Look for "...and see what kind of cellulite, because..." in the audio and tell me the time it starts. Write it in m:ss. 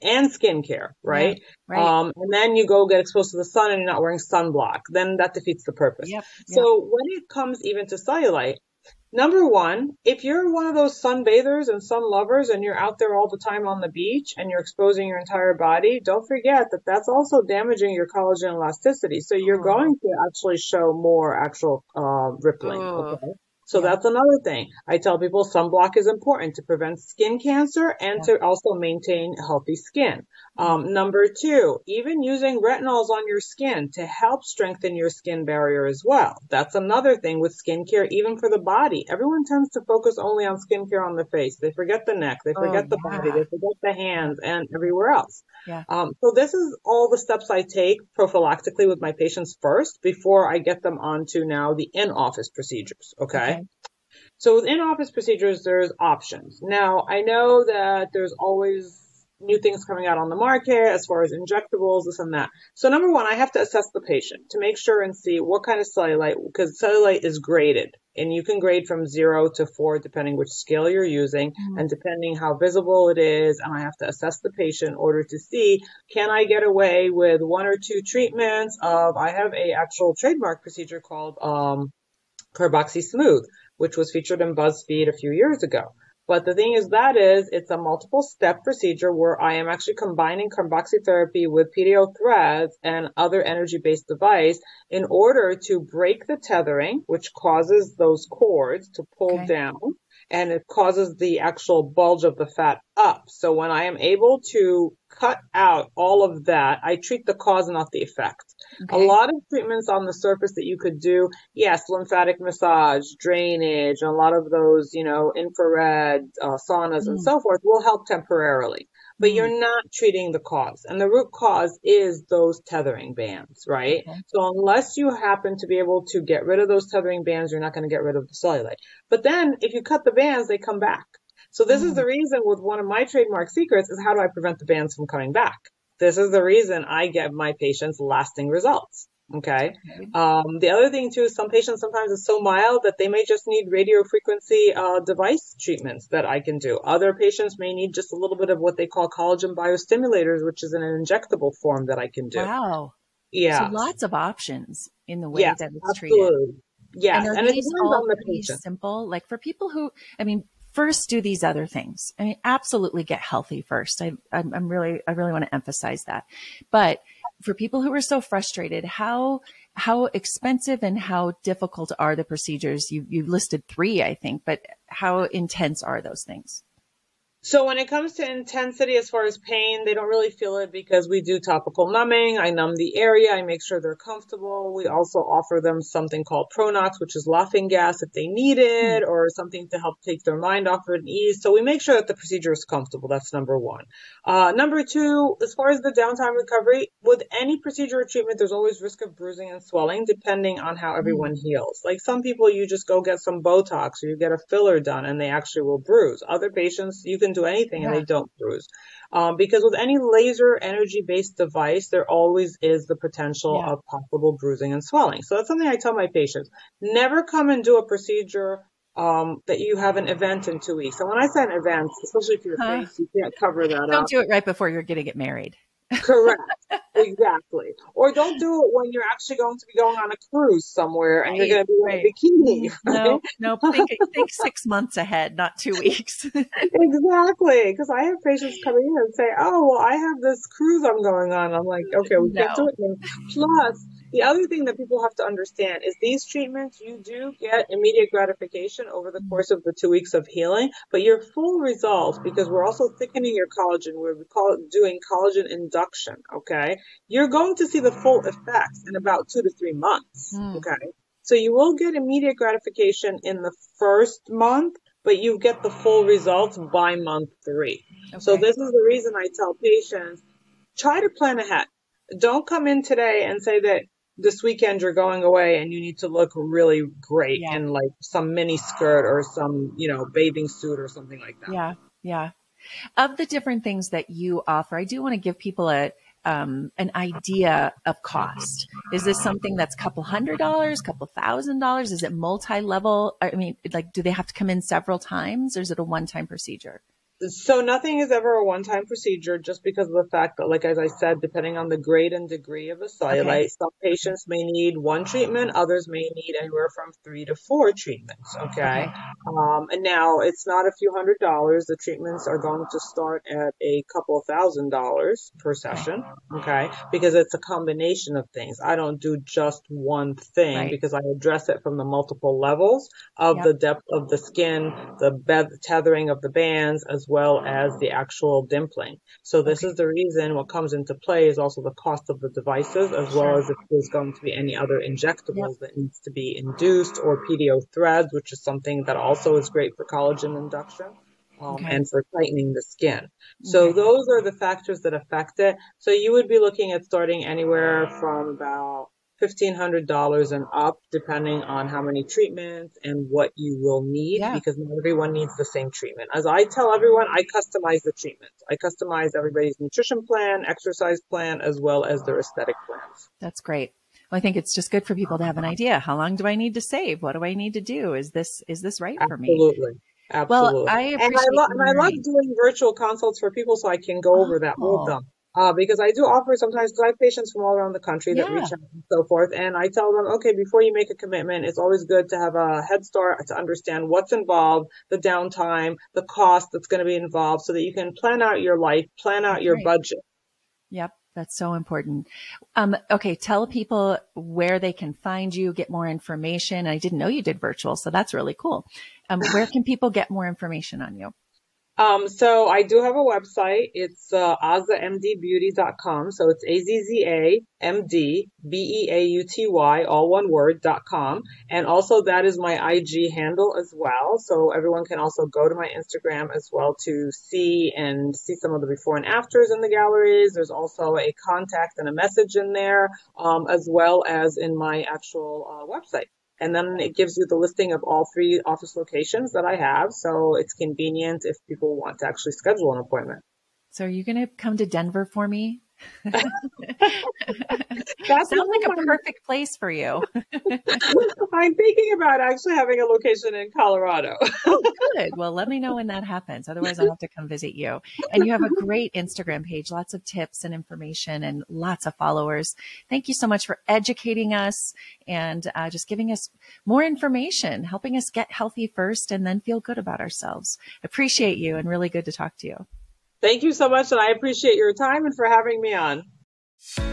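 1:05.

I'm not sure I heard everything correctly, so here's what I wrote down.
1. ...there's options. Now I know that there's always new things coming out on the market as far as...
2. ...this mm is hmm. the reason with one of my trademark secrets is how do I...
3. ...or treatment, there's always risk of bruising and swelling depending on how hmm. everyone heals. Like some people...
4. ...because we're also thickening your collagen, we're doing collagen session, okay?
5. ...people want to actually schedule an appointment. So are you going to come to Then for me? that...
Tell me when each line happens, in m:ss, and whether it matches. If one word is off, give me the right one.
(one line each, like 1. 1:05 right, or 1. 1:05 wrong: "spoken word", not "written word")
1. 0:55 right
2. 2:11 right
3. 3:18 right
4. 4:12 wrong: "induction", not "session"
5. 7:11 wrong: "Denver", not "Then".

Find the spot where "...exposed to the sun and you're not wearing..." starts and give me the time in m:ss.
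0:03.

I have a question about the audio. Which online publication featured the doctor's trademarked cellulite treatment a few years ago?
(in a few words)
BuzzFeed.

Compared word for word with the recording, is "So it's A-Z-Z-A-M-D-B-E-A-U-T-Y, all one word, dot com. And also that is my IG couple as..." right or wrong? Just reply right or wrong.
wrong.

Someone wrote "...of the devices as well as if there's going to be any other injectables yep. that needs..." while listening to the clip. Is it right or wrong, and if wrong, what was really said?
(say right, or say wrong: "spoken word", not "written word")
right.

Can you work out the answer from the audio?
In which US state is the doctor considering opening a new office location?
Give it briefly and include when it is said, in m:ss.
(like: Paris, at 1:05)
Colorado, at 7:23.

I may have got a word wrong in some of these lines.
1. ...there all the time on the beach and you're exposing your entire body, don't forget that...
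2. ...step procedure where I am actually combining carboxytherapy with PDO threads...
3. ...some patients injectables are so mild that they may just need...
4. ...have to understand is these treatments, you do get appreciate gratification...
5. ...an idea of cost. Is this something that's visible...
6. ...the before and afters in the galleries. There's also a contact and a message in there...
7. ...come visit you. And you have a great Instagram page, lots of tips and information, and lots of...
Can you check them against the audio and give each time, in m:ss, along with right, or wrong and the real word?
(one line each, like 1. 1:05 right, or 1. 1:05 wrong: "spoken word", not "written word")
1. 0:12 right
2. 1:28 right
3. 2:21 wrong: "sometimes", not "injectables"
4. 4:05 wrong: "immediate", not "appreciate"
5. 4:46 wrong: "couple", not "visible"
6. 6:58 right
7. 7:27 right.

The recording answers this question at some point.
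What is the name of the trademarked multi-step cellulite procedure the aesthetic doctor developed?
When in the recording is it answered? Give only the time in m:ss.
1:22.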